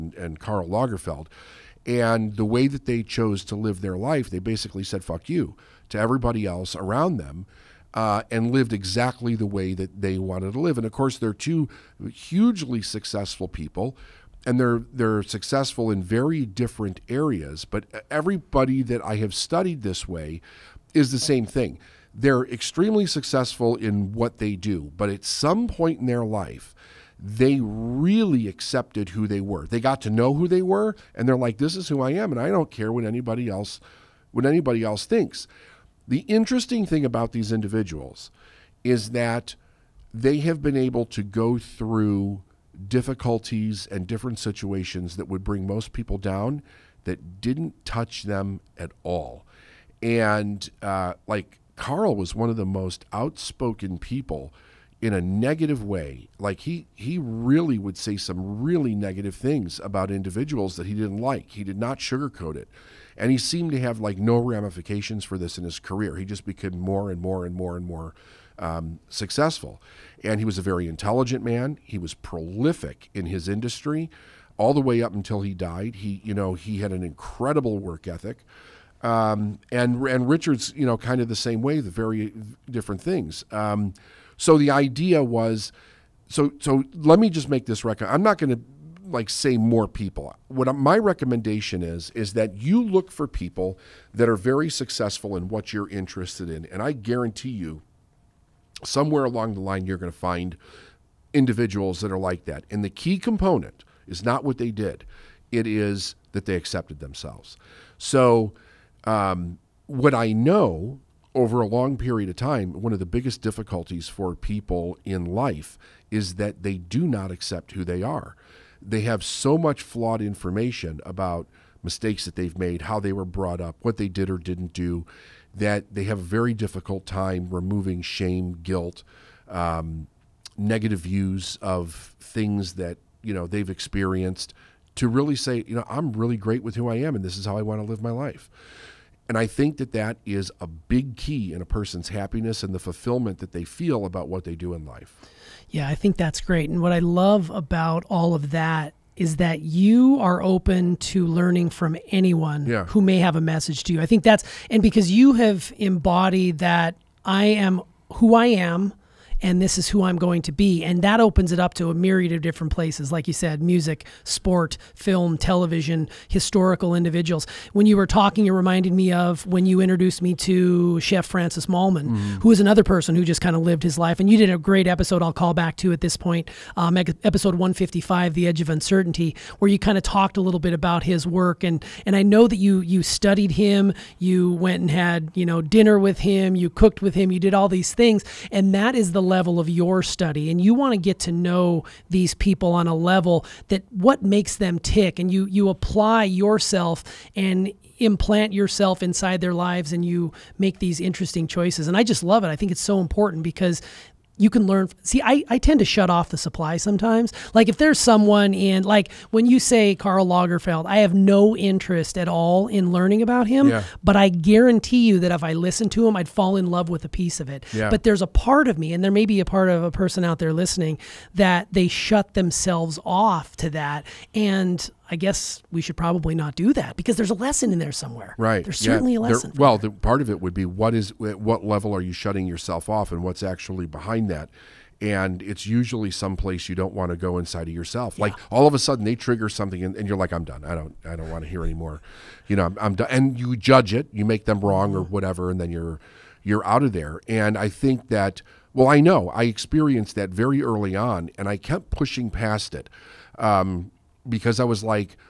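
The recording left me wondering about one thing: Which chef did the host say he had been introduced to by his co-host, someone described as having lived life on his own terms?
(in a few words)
Francis Mallmann.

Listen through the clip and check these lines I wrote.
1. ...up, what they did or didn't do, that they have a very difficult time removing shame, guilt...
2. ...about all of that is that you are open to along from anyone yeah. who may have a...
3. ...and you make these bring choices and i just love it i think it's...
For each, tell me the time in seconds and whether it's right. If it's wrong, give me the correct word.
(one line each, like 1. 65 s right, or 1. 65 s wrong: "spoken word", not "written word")
1. 123 s right
2. 147 s wrong: "learning", not "along"
3. 199 s wrong: "interesting", not "bring".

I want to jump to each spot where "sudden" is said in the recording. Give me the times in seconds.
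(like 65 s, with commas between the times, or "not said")
238 s.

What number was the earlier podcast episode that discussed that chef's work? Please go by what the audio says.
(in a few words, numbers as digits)
155.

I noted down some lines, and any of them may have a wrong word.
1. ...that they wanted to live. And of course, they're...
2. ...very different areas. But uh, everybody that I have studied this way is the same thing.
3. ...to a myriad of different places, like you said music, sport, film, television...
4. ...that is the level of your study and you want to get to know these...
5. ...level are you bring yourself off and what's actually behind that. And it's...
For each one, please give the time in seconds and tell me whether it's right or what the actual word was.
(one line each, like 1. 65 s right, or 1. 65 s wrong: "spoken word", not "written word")
1. 9 s right
2. 16 s right
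3. 161 s right
4. 188 s right
5. 231 s wrong: "shutting", not "bring".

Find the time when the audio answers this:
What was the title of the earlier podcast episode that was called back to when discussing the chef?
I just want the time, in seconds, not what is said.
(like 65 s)
178 s.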